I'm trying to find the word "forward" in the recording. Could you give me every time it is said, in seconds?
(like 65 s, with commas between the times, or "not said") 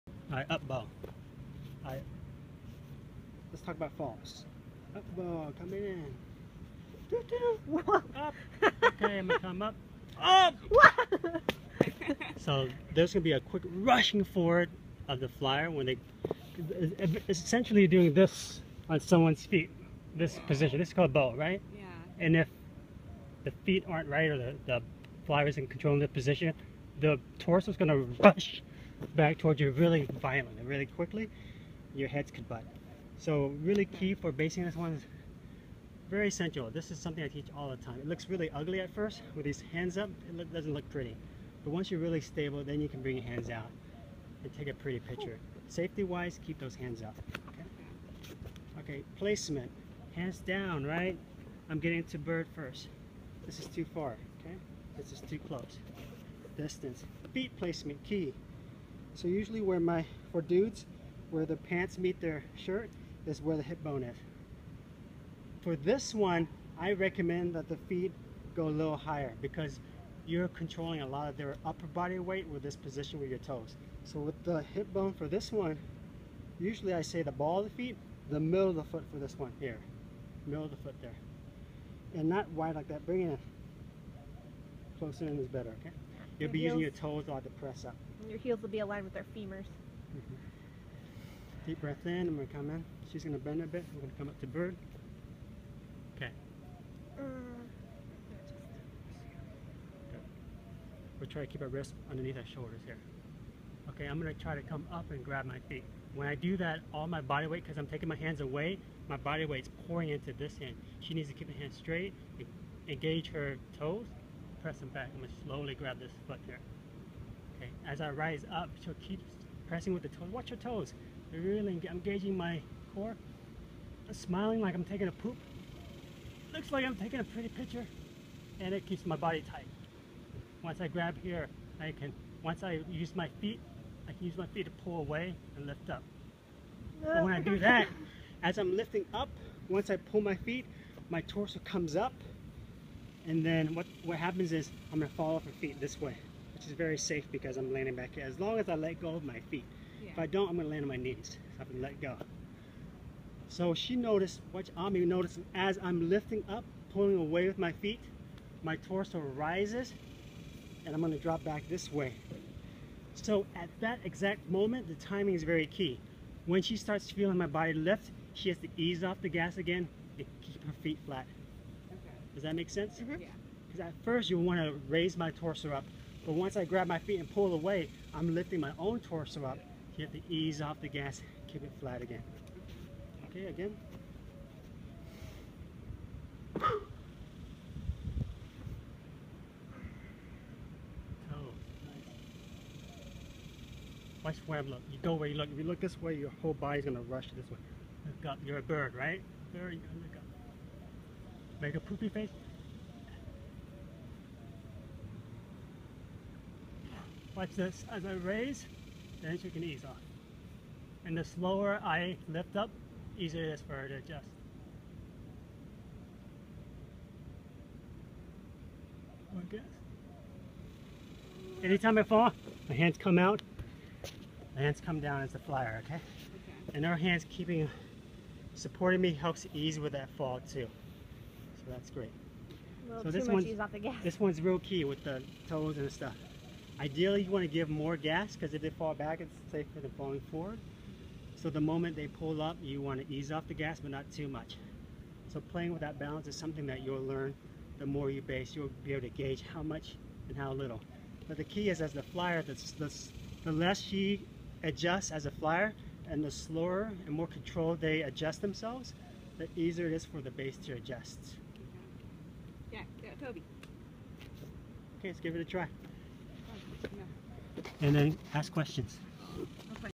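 14 s, 240 s.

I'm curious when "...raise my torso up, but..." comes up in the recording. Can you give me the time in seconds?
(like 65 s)
174 s.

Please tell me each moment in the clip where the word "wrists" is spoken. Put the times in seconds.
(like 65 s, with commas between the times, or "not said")
101 s.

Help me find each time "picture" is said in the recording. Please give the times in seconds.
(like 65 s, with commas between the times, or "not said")
44 s, 127 s.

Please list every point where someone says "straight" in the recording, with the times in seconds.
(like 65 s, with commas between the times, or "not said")
111 s.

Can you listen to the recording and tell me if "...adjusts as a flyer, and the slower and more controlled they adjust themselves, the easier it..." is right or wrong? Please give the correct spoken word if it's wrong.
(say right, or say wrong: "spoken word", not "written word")
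right.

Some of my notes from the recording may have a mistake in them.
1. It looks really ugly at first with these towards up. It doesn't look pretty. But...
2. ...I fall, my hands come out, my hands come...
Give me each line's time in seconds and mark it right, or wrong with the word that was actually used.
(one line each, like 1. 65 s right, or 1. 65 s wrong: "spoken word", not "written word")
1. 37 s wrong: "hands", not "towards"
2. 221 s right.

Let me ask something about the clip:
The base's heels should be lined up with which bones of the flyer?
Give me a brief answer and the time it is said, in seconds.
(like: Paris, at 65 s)
femurs, at 89 s.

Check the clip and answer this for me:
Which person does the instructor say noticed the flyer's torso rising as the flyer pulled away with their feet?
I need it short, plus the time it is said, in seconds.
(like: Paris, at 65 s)
Ami, at 154 s.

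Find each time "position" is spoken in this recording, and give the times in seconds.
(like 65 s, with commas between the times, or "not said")
20 s, 26 s, 72 s.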